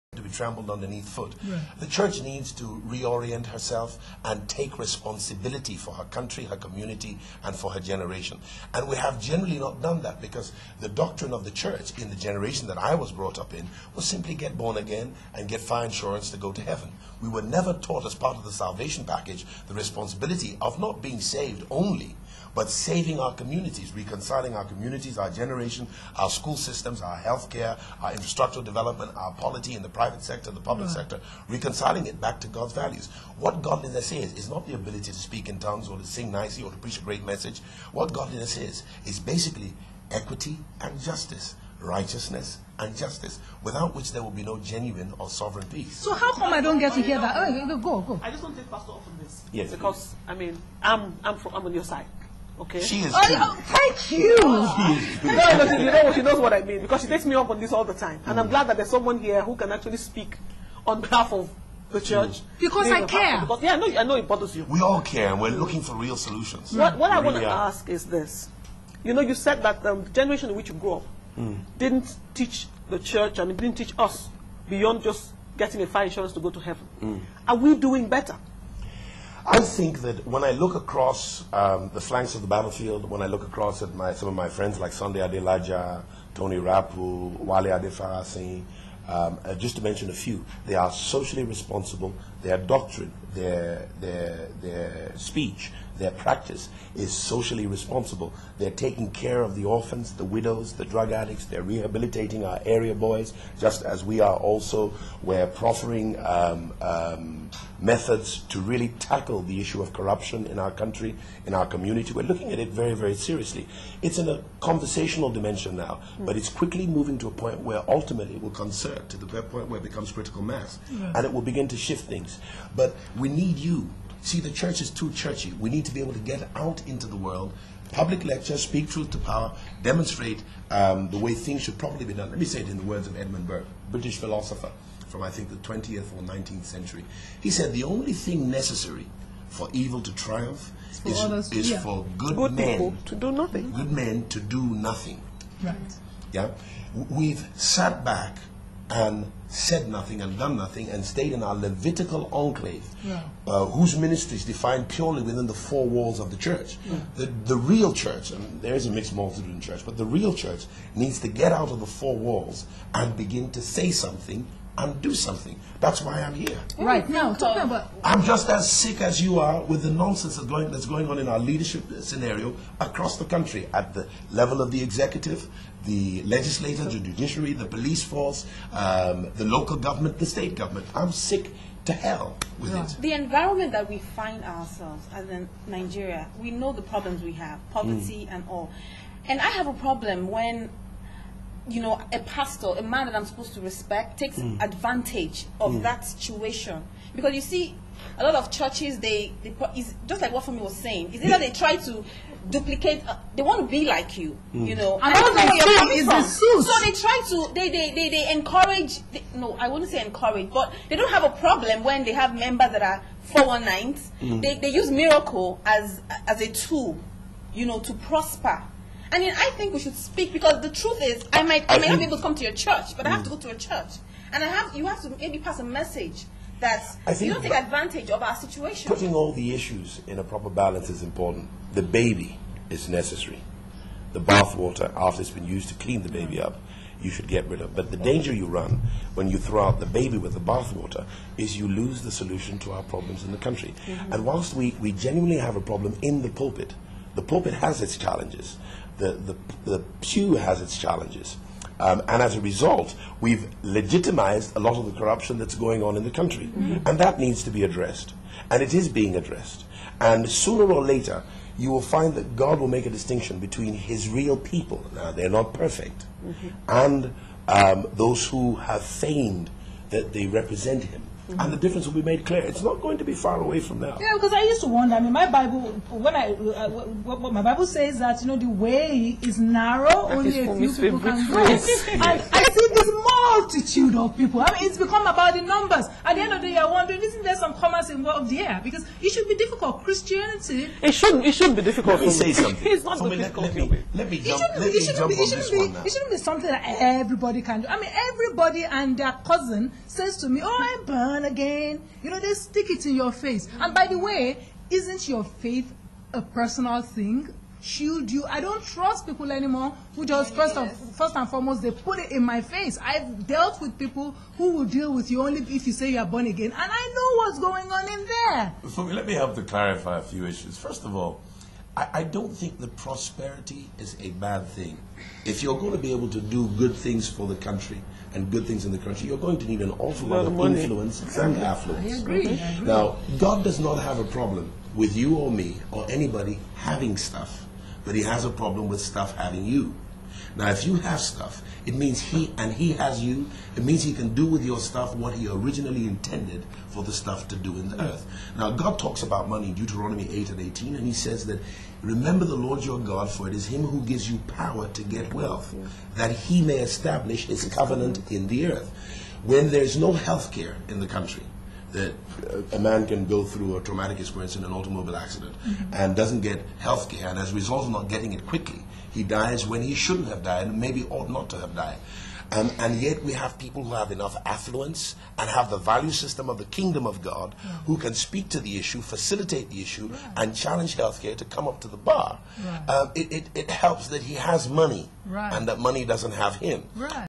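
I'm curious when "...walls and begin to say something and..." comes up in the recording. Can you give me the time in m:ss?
2:42.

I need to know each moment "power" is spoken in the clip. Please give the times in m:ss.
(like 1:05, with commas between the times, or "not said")
2:09, 5:54.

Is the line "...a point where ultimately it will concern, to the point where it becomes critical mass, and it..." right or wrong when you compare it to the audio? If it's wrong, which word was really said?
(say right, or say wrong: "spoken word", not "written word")
right.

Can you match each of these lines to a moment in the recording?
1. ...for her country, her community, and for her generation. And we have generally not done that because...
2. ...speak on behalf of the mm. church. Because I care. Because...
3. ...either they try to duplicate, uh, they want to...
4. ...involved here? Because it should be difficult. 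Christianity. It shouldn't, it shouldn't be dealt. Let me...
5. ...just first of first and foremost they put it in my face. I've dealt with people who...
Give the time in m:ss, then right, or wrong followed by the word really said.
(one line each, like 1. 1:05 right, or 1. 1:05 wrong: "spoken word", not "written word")
1. 0:05 right
2. 0:59 right
3. 3:21 right
4. 4:47 wrong: "difficult", not "dealt"
5. 5:10 right.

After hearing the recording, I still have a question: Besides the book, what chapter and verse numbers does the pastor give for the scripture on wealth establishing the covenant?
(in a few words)
8 and 18.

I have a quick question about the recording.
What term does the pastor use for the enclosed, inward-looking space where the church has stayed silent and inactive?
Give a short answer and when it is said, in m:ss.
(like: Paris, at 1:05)
Levitical enclave, at 2:31.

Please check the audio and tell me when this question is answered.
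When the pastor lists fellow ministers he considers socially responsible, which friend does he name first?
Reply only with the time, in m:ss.
1:24.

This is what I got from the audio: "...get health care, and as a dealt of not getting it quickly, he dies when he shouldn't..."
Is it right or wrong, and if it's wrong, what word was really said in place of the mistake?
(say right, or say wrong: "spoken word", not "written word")
wrong: "result", not "dealt".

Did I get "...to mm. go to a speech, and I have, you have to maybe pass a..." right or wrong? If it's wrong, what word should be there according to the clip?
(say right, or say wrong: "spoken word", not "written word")
wrong: "church", not "speech".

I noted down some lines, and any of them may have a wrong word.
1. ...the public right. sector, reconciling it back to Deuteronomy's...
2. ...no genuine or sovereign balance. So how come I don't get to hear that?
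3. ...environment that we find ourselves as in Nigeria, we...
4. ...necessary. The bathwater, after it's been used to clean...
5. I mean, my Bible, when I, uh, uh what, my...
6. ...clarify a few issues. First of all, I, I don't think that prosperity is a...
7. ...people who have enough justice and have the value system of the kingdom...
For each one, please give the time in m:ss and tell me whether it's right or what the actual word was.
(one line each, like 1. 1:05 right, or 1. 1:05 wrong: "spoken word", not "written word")
1. 0:30 wrong: "God", not "Deuteronomy"
2. 0:44 wrong: "peace", not "balance"
3. 3:03 right
4. 3:52 right
5. 4:34 right
6. 5:19 right
7. 6:13 wrong: "affluence", not "justice".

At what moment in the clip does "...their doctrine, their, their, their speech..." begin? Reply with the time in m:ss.
1:32.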